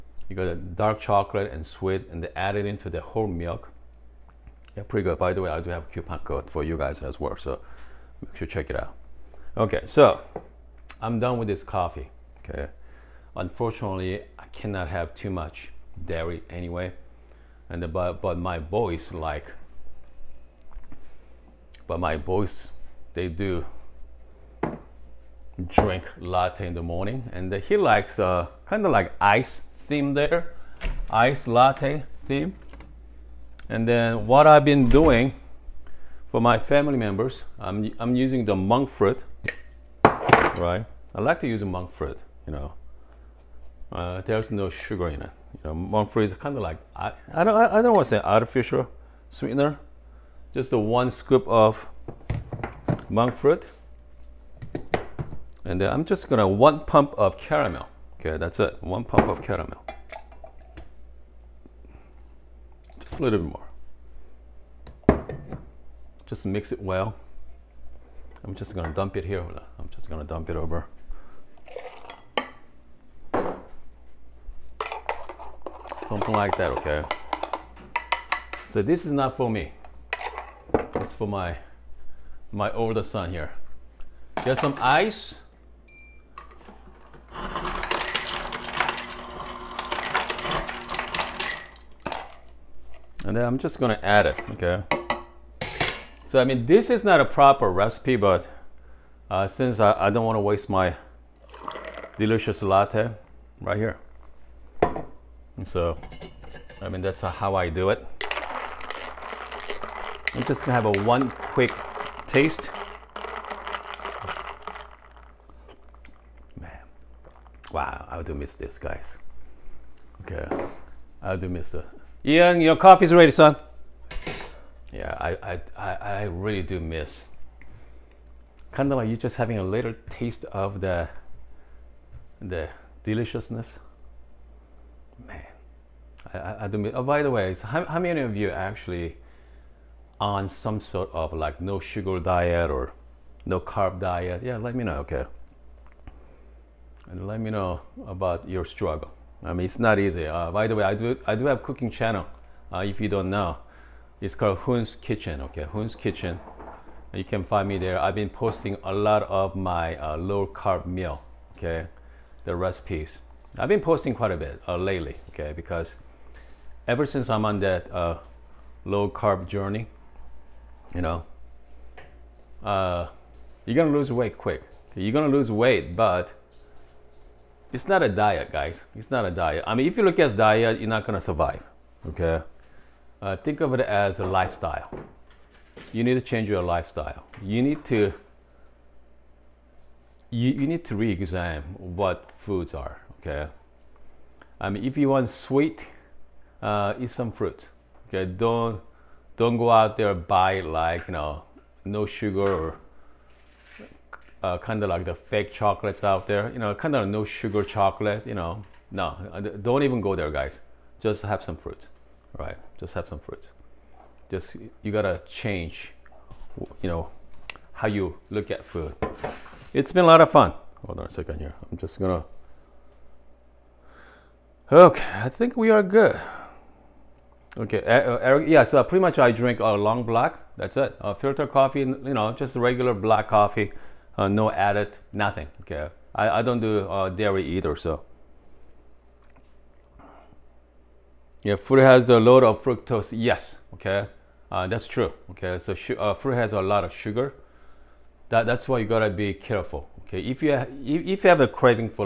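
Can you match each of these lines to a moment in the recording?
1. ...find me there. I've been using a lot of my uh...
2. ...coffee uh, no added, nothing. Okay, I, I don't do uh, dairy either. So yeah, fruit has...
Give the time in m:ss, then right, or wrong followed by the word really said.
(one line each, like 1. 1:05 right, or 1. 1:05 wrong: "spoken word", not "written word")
1. 2:37 wrong: "posting", not "using"
2. 3:53 right.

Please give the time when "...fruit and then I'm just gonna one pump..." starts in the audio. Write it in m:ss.
0:53.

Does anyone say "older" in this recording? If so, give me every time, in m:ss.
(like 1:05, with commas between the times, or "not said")
1:22.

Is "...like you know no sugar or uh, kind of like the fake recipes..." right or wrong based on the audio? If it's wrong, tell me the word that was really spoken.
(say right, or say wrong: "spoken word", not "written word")
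wrong: "chocolates", not "recipes".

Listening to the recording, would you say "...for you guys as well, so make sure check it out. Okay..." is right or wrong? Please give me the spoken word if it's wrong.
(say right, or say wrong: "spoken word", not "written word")
right.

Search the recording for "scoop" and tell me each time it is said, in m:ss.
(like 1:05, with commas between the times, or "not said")
0:51.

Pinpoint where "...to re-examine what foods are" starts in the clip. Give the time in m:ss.
3:10.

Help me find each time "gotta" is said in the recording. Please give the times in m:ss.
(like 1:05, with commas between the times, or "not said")
3:34, 4:08.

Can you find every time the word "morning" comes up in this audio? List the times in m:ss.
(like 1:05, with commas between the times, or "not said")
0:26.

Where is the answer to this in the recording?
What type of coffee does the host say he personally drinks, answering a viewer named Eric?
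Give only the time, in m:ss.
3:49.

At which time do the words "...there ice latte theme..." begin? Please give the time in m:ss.
0:30.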